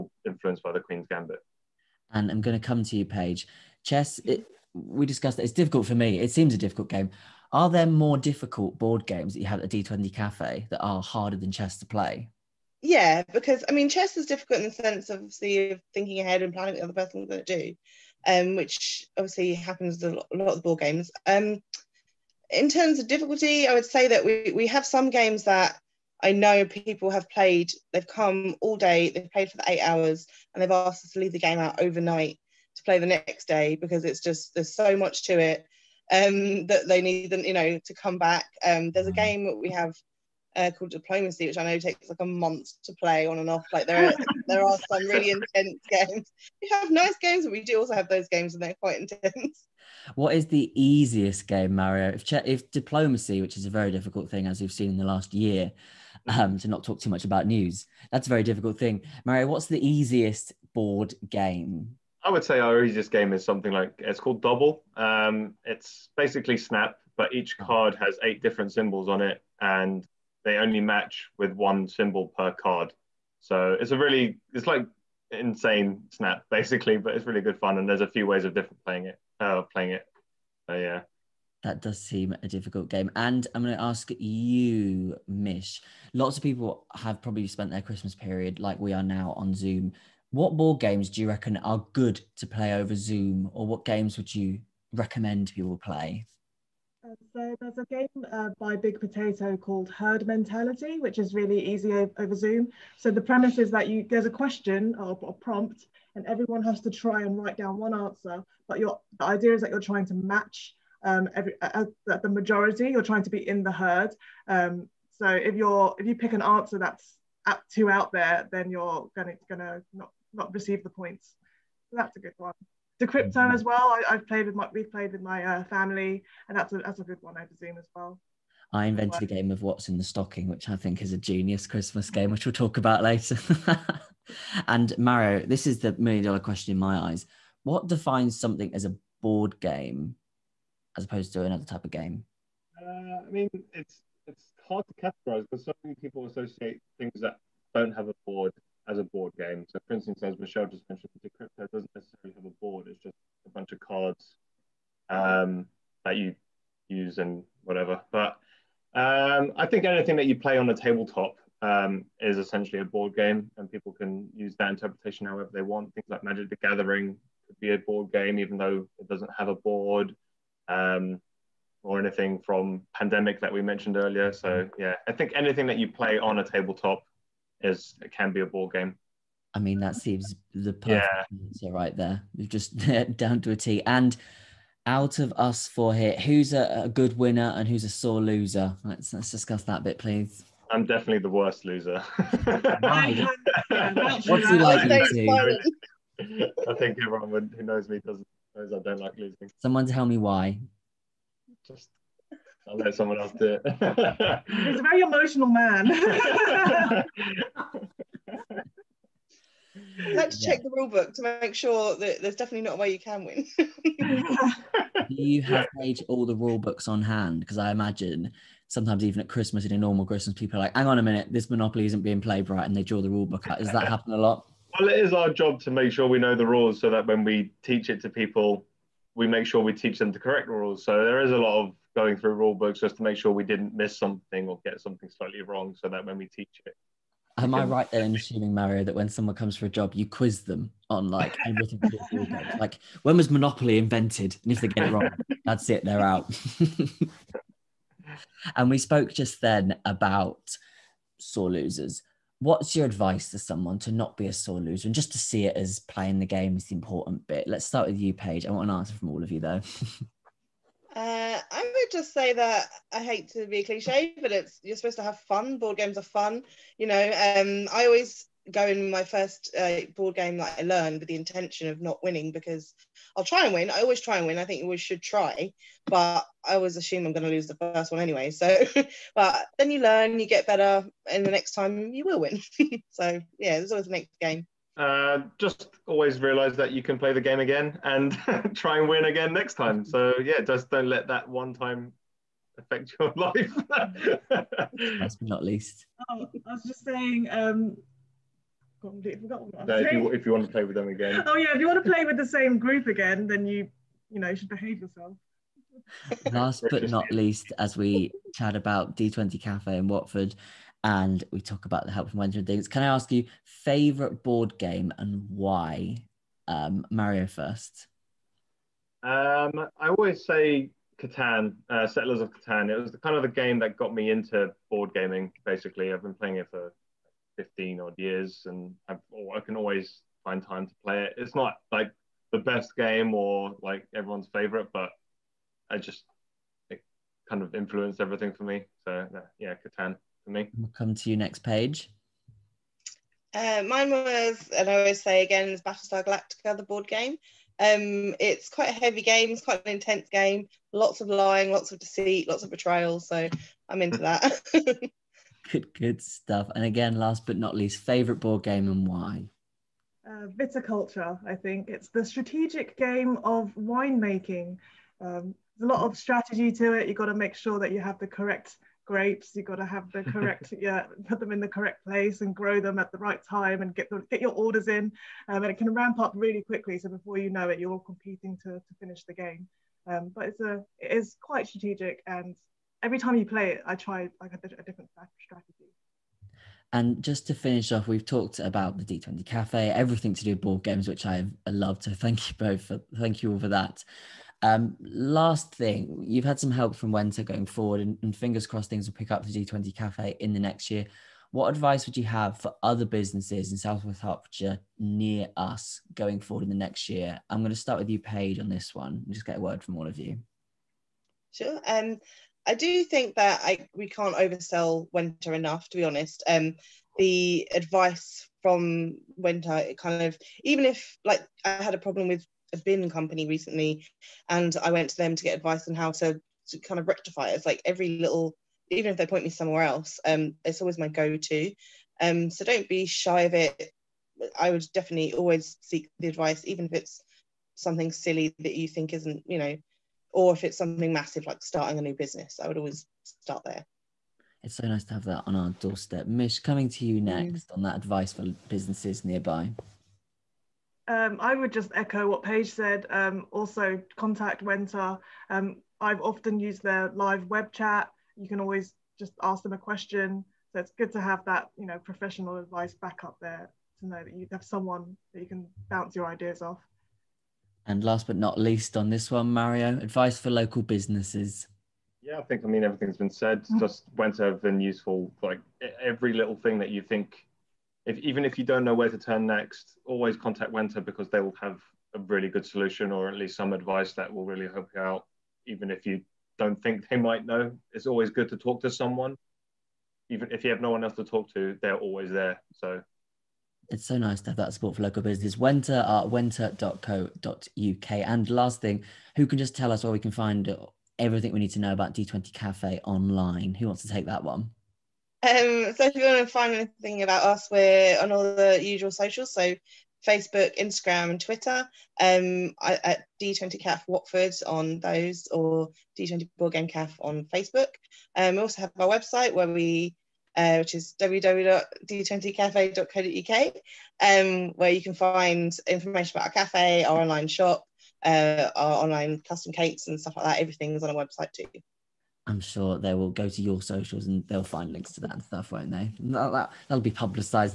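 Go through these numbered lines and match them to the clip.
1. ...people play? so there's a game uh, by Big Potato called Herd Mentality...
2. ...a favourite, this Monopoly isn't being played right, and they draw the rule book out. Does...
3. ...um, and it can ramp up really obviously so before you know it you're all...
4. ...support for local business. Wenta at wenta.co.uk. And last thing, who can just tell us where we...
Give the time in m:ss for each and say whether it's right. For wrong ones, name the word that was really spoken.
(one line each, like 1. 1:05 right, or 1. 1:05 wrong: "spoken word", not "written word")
1. 1:35 right
2. 3:40 wrong: "minute", not "favourite"
3. 6:15 wrong: "quickly", not "obviously"
4. 8:14 right.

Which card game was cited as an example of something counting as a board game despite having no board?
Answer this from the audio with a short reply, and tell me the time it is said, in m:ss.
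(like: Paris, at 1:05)
Magic the Gathering, at 2:46.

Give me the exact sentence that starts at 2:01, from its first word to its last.
So that's a good one the crypto mm-hmm.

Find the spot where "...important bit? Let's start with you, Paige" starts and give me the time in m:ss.
4:16.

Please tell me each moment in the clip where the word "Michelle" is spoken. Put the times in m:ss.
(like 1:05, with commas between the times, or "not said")
2:30.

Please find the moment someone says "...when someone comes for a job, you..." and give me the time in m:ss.
3:58.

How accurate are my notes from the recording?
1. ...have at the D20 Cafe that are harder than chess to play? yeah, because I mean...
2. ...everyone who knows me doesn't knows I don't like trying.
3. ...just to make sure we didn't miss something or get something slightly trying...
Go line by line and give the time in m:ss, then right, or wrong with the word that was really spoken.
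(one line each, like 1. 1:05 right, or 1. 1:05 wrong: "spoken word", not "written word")
1. 0:09 right
2. 3:17 wrong: "losing", not "trying"
3. 3:52 wrong: "wrong", not "trying".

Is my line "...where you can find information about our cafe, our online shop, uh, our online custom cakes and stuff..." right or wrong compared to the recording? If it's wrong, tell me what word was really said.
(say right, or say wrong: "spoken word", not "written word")
right.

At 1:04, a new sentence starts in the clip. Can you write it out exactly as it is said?
Um, it's basically Snap, but each oh.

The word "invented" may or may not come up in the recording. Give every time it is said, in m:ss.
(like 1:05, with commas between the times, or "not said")
2:08, 4:03.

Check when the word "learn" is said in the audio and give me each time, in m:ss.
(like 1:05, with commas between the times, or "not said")
4:30, 4:39.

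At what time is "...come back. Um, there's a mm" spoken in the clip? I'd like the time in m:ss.
0:37.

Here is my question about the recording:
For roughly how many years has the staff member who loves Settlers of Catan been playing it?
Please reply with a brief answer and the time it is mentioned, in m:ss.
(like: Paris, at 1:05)
15, at 5:27.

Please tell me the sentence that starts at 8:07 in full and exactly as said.
It's always good to talk to someone.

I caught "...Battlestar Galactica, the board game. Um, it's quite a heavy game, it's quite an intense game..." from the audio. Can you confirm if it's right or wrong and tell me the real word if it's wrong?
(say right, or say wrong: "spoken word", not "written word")
right.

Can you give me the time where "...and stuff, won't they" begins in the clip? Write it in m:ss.
8:55.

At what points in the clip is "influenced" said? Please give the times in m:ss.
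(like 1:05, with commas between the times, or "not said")
0:00, 5:37.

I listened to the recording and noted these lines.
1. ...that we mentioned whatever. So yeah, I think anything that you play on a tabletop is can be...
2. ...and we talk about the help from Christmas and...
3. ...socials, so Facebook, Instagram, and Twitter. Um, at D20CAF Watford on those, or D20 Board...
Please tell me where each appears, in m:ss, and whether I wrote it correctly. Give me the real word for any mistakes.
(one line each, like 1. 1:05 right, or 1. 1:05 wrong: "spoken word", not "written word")
1. 2:53 wrong: "earlier", not "whatever"
2. 5:10 wrong: "Wenta", not "Christmas"
3. 8:28 right.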